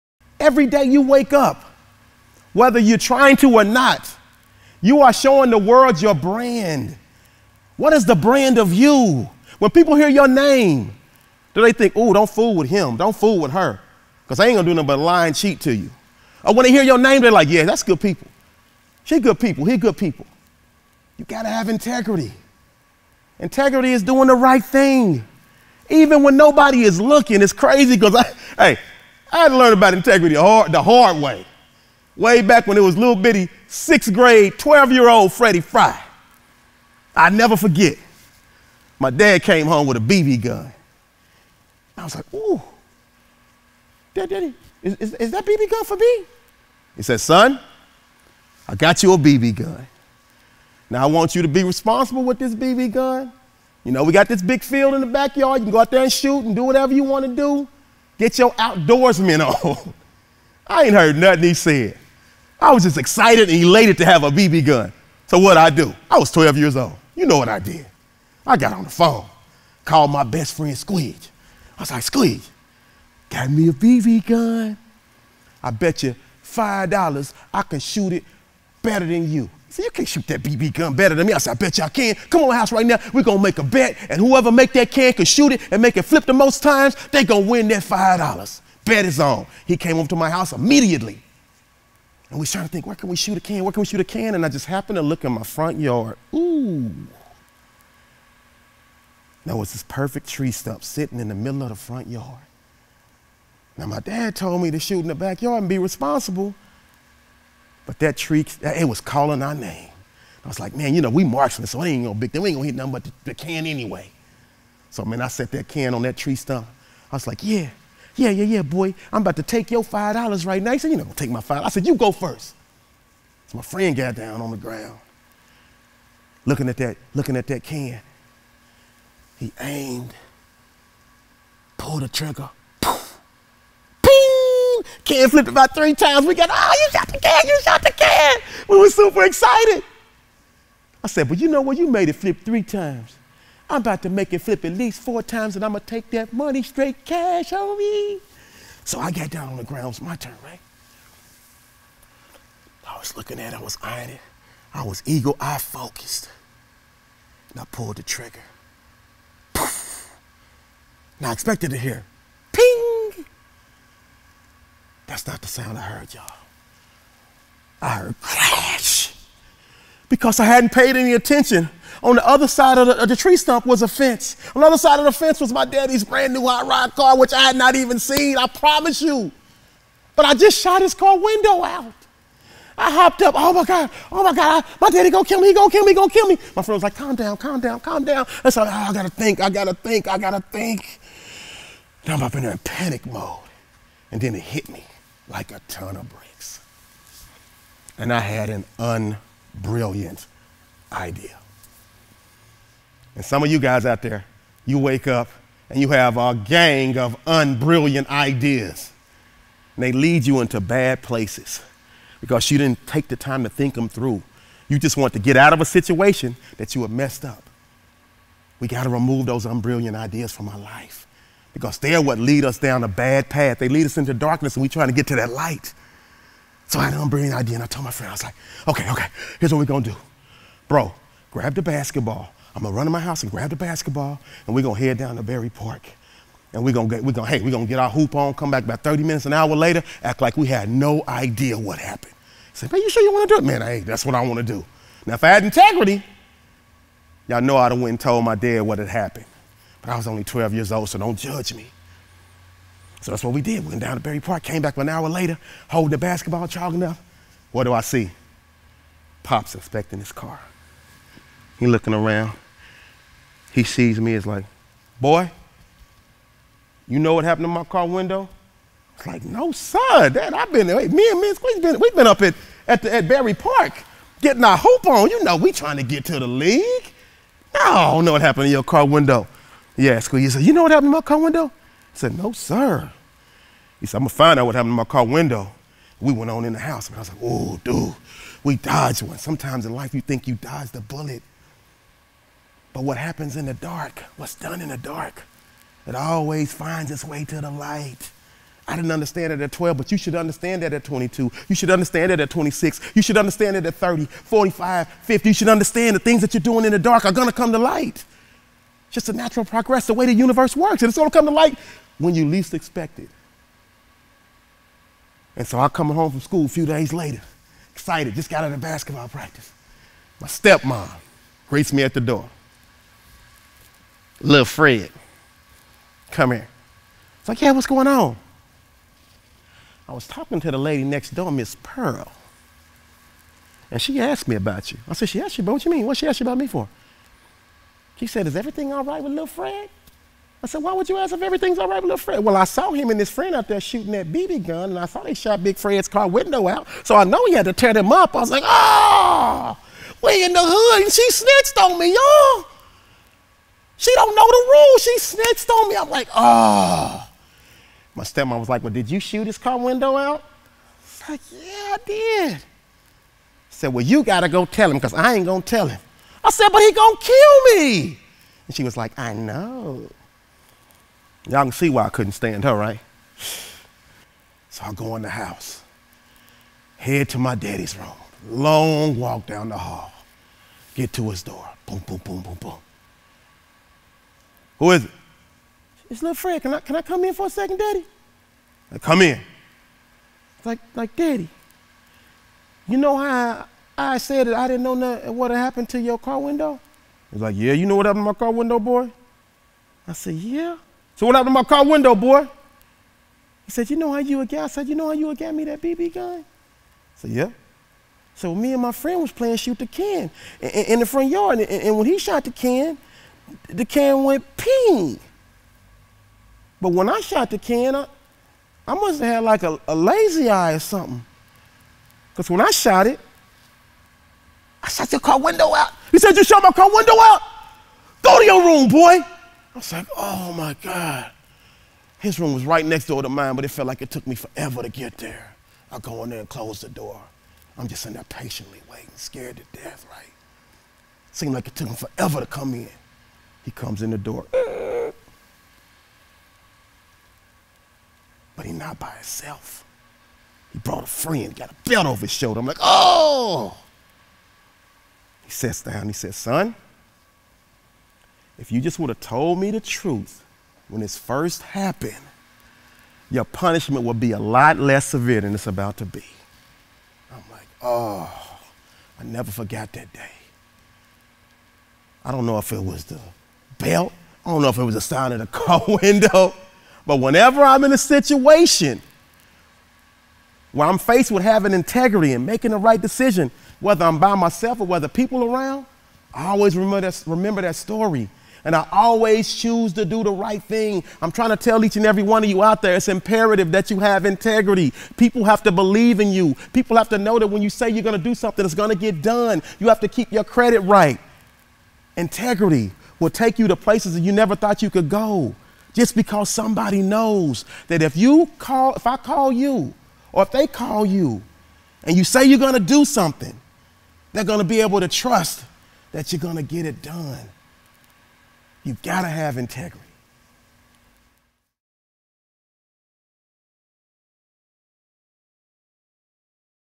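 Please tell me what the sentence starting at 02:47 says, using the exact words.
I heard crash because I hadn't paid any attention.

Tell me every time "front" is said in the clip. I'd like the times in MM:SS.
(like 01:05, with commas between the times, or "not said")
01:35, 01:41, 06:50.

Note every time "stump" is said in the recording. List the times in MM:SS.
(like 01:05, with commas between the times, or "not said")
01:40, 01:56, 02:53.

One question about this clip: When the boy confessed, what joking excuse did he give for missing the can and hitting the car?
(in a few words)
lazy eye.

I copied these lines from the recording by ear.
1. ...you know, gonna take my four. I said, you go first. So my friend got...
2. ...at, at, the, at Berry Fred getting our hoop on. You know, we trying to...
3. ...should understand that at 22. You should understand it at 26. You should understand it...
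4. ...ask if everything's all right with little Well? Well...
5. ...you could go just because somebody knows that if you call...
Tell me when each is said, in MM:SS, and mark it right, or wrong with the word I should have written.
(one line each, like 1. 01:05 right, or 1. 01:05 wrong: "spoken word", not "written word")
1. 02:00 wrong: "five", not "four"
2. 04:32 wrong: "Park", not "Fred"
3. 04:59 right
4. 05:40 wrong: "Fred", not "Well"
5. 08:24 right.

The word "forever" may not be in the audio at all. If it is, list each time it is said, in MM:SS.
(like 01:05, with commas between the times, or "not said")
07:14, 07:21.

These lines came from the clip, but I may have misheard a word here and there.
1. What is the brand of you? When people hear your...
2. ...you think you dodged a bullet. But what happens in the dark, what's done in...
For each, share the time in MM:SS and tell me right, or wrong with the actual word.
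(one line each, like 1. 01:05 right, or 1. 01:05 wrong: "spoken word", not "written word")
1. 00:07 right
2. 04:49 right.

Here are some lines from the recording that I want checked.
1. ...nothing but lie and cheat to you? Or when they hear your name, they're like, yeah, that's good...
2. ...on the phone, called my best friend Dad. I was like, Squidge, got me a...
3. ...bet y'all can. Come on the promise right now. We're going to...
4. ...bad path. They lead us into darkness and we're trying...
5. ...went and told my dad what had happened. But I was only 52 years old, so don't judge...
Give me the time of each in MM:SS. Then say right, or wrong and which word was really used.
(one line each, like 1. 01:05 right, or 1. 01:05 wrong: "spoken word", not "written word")
1. 00:14 right
2. 01:08 wrong: "Squidge", not "Dad"
3. 01:21 wrong: "house", not "promise"
4. 03:42 right
5. 04:07 wrong: "12", not "52".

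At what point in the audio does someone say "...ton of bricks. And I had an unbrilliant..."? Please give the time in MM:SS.
03:15.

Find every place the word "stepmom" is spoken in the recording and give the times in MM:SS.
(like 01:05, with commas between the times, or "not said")
05:20, 05:58.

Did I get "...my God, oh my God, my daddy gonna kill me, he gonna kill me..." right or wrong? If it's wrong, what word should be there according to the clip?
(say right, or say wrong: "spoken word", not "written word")
right.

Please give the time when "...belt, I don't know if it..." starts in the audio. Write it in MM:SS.
07:53.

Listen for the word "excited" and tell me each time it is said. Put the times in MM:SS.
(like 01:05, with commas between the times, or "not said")
01:02, 02:19, 05:17.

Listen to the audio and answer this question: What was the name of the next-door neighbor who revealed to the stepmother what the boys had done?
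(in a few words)
Miss Pearl.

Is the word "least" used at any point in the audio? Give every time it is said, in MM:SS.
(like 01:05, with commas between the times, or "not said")
02:24, 05:12.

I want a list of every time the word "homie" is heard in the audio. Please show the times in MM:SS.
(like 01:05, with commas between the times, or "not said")
02:27.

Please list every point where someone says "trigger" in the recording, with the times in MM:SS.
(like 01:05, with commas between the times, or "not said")
02:12, 02:38.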